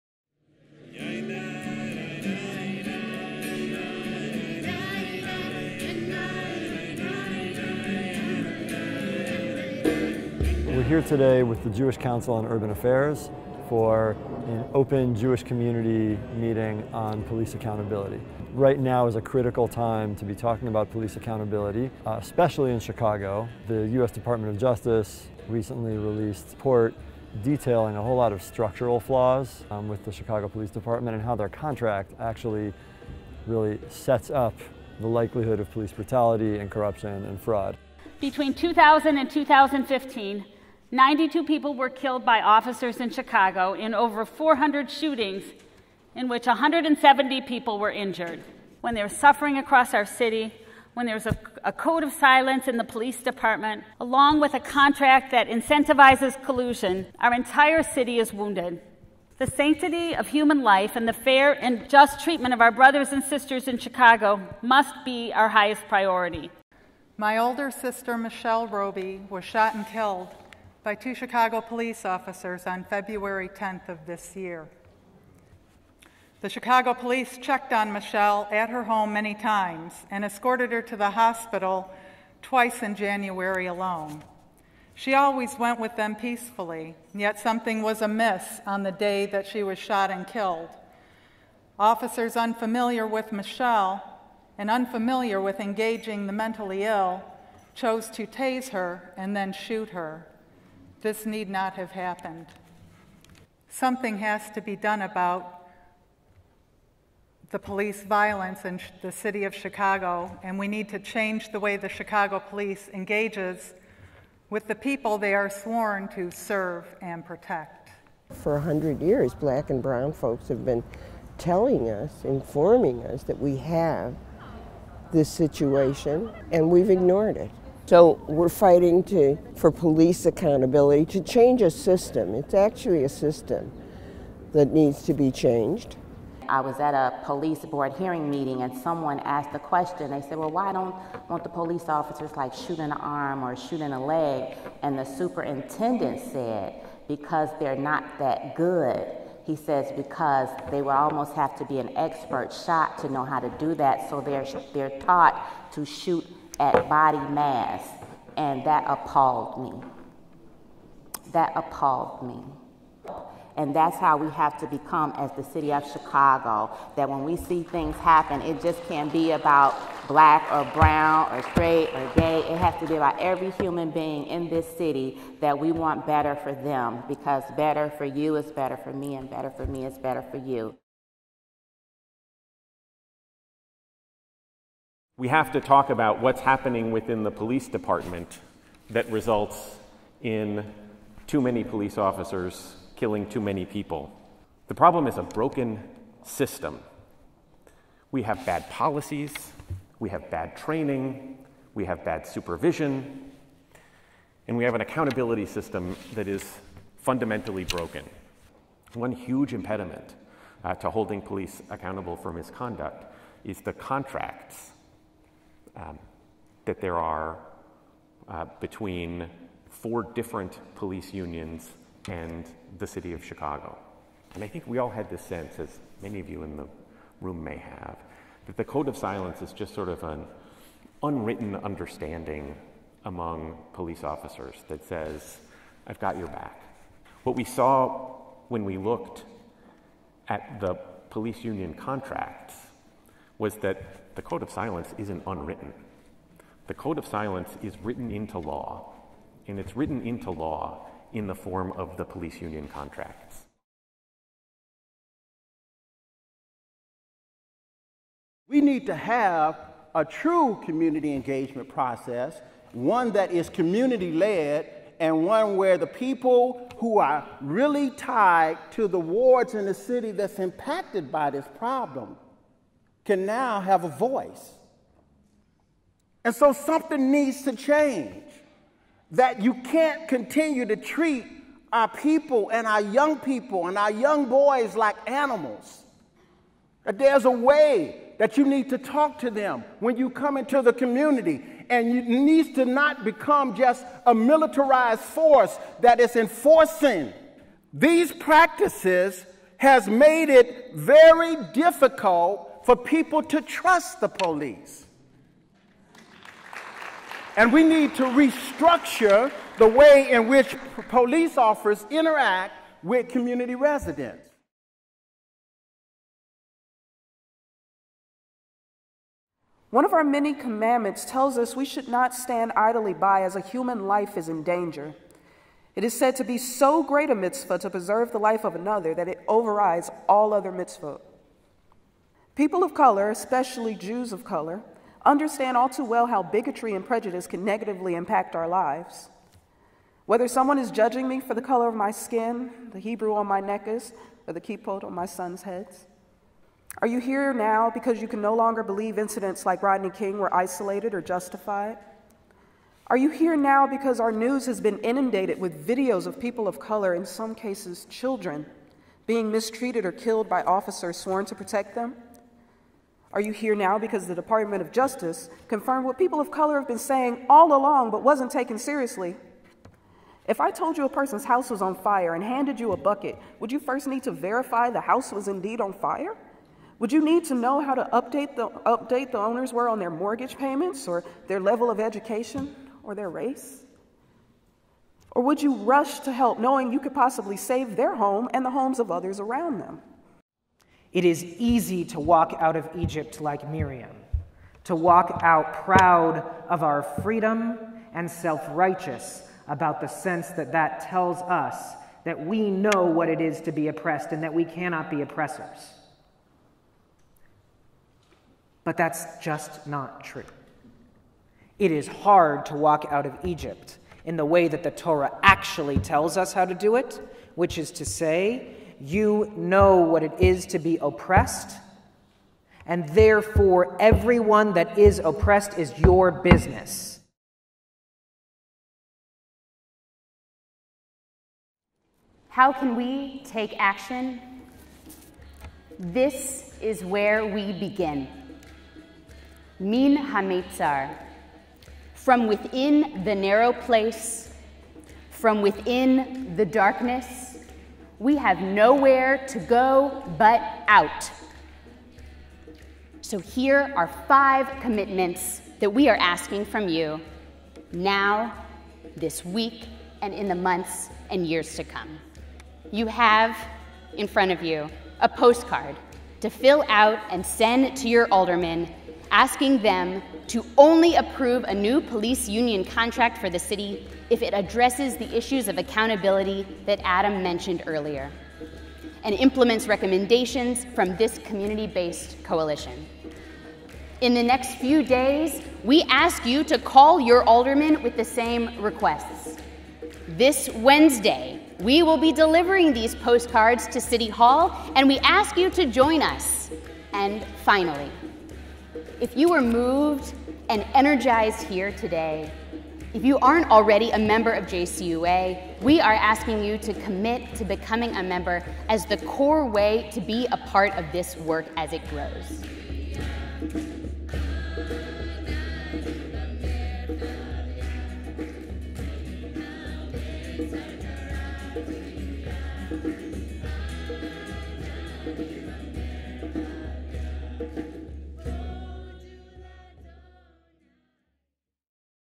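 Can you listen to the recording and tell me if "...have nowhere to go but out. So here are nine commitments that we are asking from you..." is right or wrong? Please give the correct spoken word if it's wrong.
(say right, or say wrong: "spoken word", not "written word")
wrong: "five", not "nine".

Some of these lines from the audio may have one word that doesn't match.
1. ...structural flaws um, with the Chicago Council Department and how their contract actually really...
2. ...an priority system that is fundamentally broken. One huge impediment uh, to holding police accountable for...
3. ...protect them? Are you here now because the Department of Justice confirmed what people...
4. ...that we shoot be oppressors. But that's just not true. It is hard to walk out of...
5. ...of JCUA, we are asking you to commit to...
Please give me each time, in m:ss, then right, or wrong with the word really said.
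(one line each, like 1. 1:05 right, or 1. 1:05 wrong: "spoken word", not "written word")
1. 0:28 wrong: "Police", not "Council"
2. 3:24 wrong: "accountability", not "priority"
3. 6:01 right
4. 6:44 wrong: "cannot", not "shoot"
5. 8:24 right.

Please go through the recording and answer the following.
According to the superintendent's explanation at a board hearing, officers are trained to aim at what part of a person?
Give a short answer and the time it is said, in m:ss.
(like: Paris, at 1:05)
body mass, at 2:36.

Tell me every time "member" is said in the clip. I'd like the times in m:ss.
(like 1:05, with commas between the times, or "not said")
8:23, 8:28.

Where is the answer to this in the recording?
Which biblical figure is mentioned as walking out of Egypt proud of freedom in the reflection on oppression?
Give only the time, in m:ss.
6:33.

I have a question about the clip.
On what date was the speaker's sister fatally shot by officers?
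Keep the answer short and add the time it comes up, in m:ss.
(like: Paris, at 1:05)
February 10th, at 1:12.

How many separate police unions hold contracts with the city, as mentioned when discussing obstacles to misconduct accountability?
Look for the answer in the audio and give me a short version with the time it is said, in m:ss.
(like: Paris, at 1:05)
4, at 3:39.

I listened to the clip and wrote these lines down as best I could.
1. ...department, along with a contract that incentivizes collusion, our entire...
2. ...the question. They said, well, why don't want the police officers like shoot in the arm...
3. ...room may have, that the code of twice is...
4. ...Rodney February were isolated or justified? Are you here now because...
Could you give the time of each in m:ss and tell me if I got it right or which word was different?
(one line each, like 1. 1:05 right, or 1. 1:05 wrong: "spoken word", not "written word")
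1. 0:53 right
2. 2:19 right
3. 3:47 wrong: "silence", not "twice"
4. 5:49 wrong: "King", not "February".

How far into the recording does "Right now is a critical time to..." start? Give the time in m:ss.
0:18.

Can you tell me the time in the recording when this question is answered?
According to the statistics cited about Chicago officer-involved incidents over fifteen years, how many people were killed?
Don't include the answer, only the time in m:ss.
0:40.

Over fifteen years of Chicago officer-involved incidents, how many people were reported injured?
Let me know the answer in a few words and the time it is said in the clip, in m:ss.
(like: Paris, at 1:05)
170, at 0:46.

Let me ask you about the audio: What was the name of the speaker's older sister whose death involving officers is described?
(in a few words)
Michelle Roby.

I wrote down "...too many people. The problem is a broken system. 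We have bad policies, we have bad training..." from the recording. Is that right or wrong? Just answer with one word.
right.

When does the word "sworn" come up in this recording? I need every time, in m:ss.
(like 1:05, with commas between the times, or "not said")
1:55, 6:00.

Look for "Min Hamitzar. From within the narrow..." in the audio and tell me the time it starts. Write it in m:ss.
7:19.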